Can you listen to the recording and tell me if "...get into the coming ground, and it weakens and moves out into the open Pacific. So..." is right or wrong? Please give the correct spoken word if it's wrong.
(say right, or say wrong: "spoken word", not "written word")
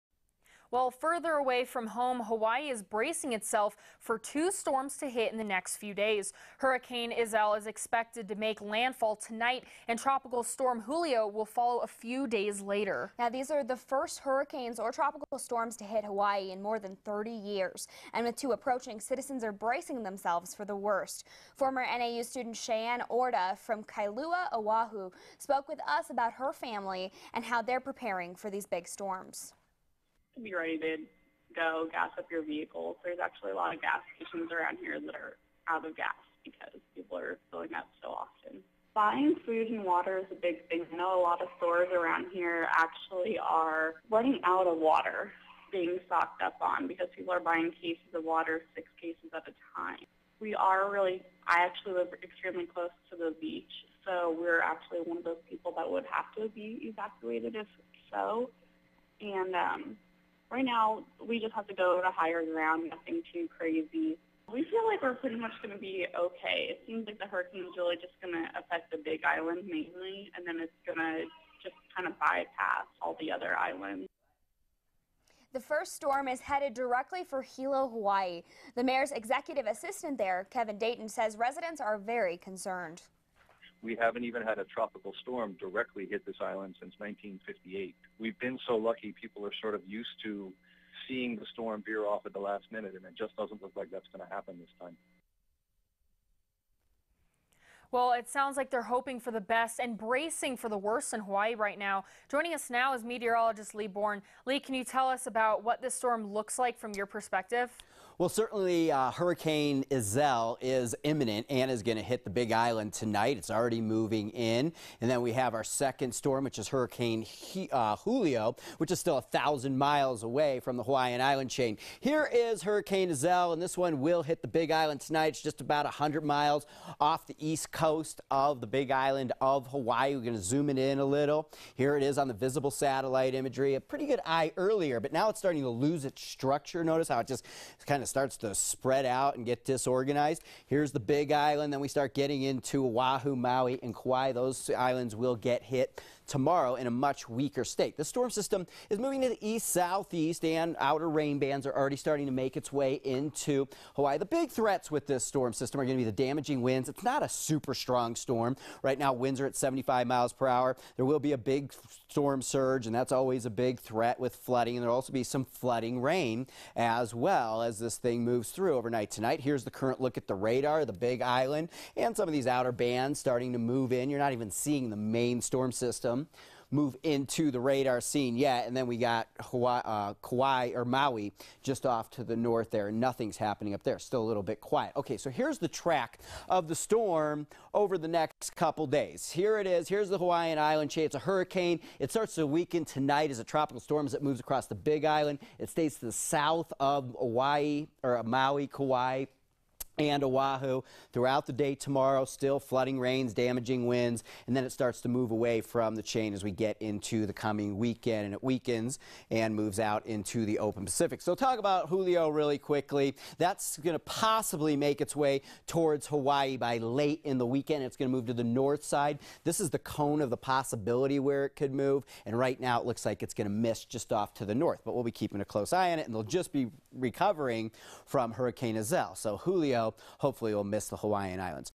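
wrong: "weekend", not "ground".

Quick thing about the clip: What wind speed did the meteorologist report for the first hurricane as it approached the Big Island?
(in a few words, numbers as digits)
75 mph.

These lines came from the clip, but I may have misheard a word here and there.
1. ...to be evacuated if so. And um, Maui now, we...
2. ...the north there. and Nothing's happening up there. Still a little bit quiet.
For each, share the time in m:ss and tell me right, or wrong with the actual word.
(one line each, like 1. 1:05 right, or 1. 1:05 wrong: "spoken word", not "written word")
1. 0:56 wrong: "Right", not "Maui"
2. 3:02 right.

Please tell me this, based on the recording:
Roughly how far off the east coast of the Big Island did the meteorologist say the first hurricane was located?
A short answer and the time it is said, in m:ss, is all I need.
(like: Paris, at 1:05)
100 miles, at 2:05.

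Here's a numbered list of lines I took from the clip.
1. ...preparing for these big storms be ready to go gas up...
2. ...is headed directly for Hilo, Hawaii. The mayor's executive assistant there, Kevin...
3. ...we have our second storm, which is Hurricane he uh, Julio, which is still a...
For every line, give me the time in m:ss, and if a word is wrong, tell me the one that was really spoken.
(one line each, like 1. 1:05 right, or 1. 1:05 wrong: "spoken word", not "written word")
1. 0:27 right
2. 1:16 right
3. 1:55 right.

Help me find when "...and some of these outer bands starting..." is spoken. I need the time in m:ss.
2:51.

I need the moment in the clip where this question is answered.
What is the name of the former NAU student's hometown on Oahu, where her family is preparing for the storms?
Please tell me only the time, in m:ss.
0:23.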